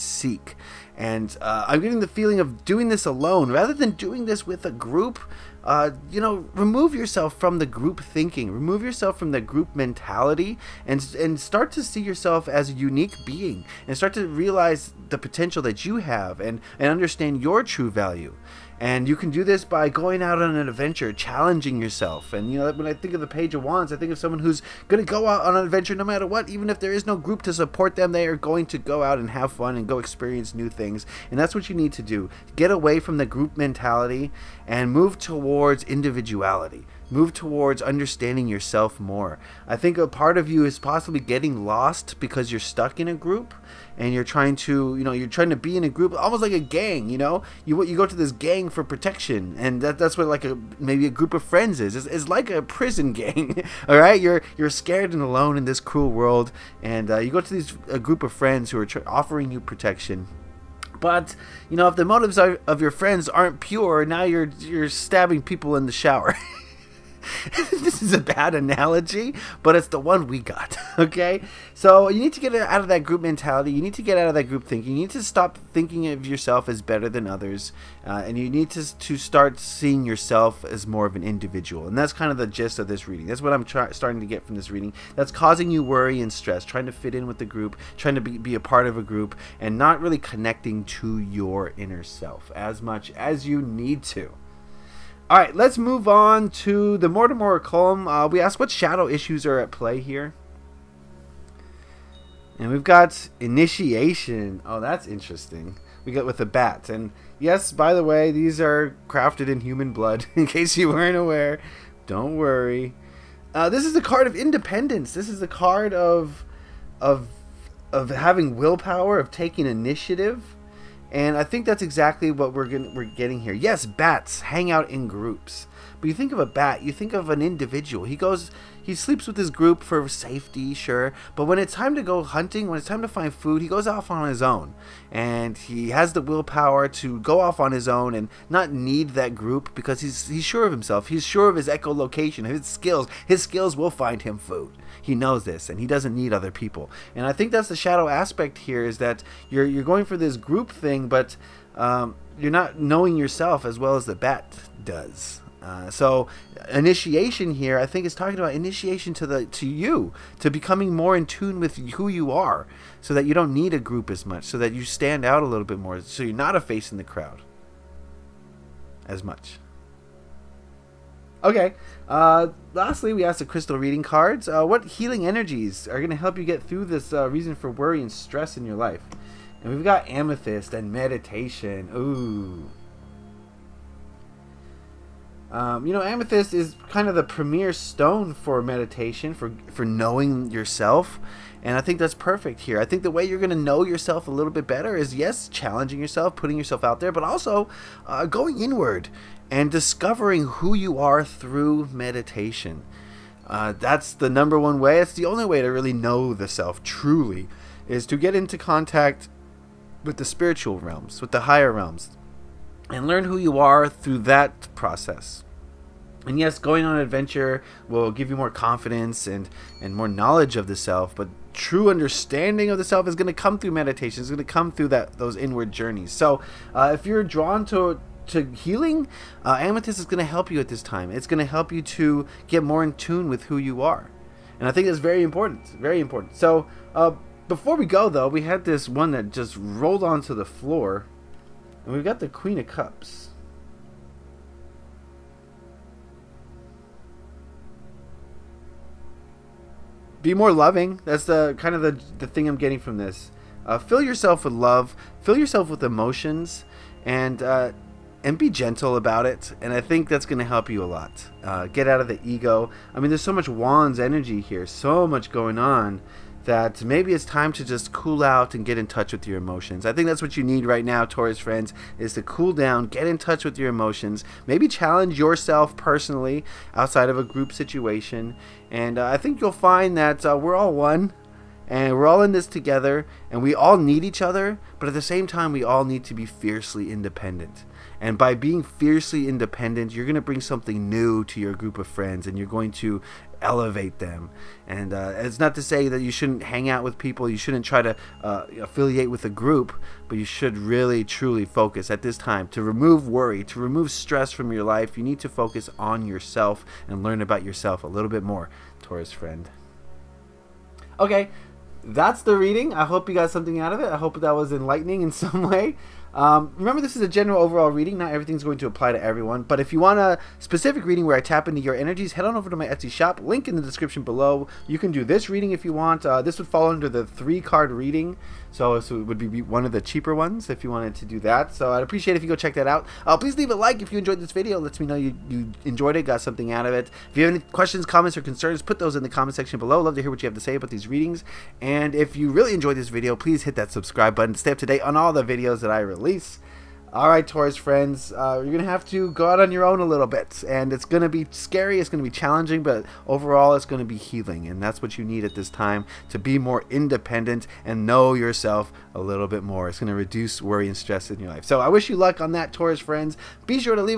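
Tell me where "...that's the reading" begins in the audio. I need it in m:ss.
5:11.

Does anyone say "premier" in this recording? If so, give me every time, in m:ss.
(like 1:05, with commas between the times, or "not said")
3:07.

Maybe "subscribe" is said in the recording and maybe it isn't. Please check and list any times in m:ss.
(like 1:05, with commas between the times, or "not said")
5:43.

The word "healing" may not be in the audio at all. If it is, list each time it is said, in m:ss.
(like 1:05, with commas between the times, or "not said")
2:54, 3:48, 5:53.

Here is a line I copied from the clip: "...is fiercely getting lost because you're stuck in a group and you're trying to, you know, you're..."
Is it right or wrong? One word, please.
wrong.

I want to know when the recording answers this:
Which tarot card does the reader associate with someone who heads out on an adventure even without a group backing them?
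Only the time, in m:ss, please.
0:23.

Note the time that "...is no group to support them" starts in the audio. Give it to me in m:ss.
0:26.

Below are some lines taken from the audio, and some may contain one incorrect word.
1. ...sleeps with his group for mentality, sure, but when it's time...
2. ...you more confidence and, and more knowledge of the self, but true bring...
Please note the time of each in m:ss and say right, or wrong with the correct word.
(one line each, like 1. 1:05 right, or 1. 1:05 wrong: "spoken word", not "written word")
1. 2:08 wrong: "safety", not "mentality"
2. 3:38 wrong: "understanding", not "bring".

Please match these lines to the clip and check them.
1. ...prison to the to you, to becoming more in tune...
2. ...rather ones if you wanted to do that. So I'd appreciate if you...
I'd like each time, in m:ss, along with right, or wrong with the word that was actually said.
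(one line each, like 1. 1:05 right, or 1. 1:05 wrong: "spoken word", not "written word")
1. 2:38 wrong: "initiation", not "prison"
2. 5:29 wrong: "cheaper", not "rather".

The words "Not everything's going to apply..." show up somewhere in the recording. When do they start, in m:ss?
5:17.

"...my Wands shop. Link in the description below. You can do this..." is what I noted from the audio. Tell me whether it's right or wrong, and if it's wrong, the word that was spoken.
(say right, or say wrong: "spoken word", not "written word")
wrong: "Etsy", not "Wands".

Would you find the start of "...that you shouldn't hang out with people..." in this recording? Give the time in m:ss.
4:55.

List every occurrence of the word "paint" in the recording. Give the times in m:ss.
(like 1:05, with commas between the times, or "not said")
not said.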